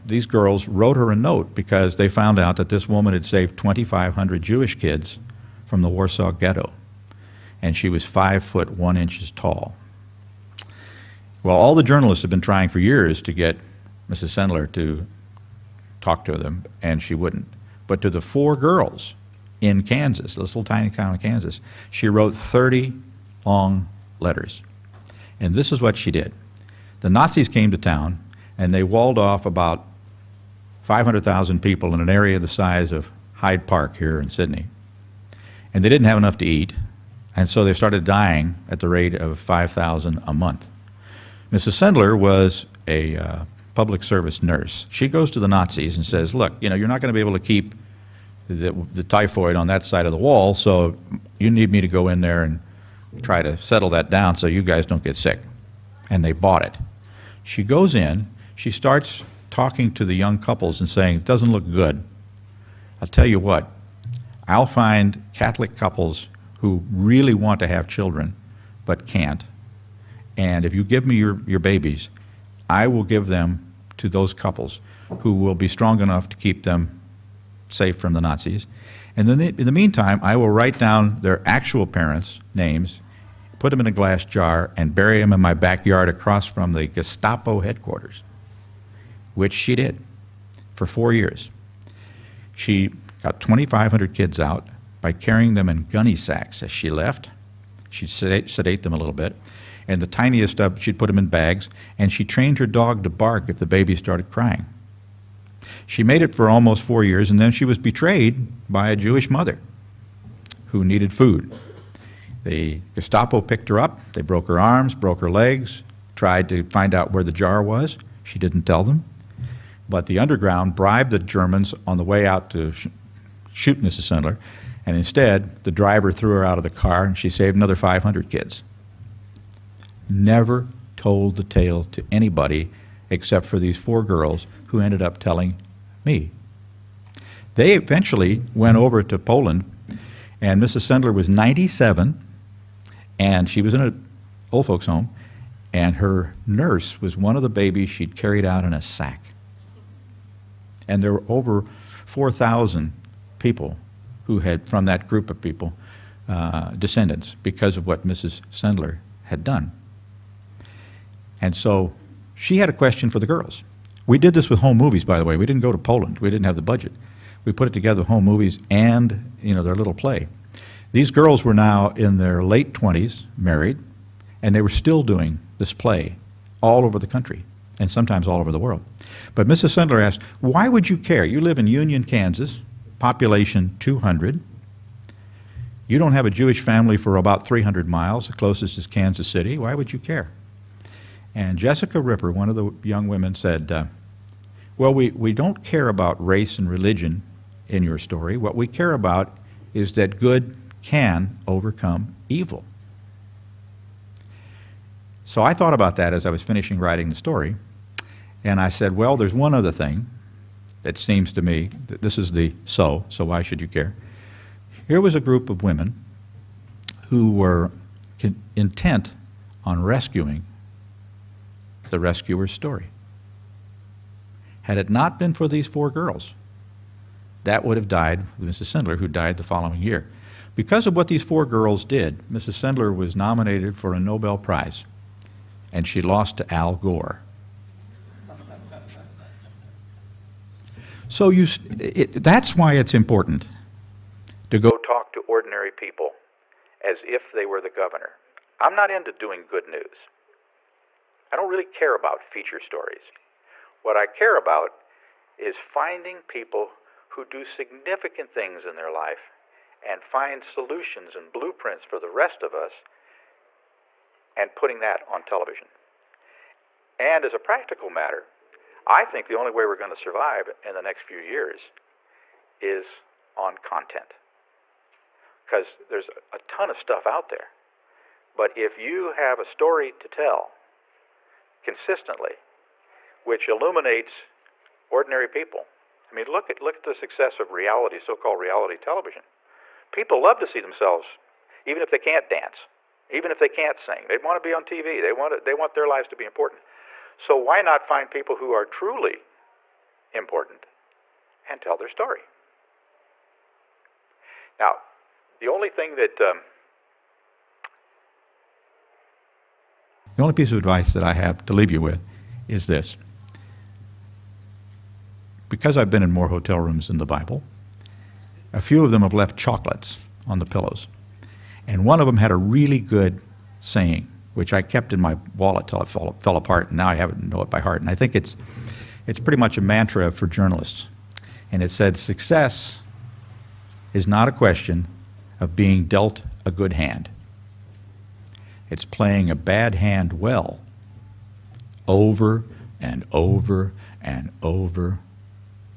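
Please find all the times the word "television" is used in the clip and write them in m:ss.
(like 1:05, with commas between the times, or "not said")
4:25, 4:48.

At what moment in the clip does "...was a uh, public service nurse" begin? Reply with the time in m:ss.
0:42.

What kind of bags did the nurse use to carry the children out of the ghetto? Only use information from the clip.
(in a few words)
Gunny sacks.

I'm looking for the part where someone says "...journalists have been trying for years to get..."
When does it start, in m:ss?
0:11.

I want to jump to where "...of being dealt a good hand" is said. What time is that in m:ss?
5:35.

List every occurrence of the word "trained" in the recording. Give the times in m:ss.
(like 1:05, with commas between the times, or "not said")
1:42.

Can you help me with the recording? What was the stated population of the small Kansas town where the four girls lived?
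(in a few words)
200.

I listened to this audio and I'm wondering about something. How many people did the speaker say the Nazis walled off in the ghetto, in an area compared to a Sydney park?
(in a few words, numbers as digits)
500,000.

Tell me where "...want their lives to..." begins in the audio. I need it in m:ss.
4:55.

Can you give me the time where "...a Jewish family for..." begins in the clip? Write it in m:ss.
3:06.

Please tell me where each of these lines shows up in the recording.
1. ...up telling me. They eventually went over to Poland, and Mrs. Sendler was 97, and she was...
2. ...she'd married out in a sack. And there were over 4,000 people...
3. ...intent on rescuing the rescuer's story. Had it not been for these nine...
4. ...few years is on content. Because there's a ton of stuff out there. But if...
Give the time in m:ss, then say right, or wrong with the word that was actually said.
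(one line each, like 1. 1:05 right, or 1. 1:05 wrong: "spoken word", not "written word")
1. 2:15 right
2. 2:27 wrong: "carried", not "married"
3. 3:38 wrong: "four", not "nine"
4. 4:31 right.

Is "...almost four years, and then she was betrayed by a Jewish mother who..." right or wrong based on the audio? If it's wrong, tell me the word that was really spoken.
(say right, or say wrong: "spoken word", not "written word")
right.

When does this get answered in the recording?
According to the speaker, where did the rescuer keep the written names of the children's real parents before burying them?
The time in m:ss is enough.
1:23.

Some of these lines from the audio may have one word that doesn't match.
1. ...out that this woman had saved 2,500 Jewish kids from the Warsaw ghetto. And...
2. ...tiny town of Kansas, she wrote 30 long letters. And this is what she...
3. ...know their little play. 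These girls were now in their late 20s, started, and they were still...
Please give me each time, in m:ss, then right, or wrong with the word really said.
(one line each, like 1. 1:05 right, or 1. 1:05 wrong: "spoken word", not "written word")
1. 0:02 right
2. 0:20 right
3. 2:49 wrong: "married", not "started".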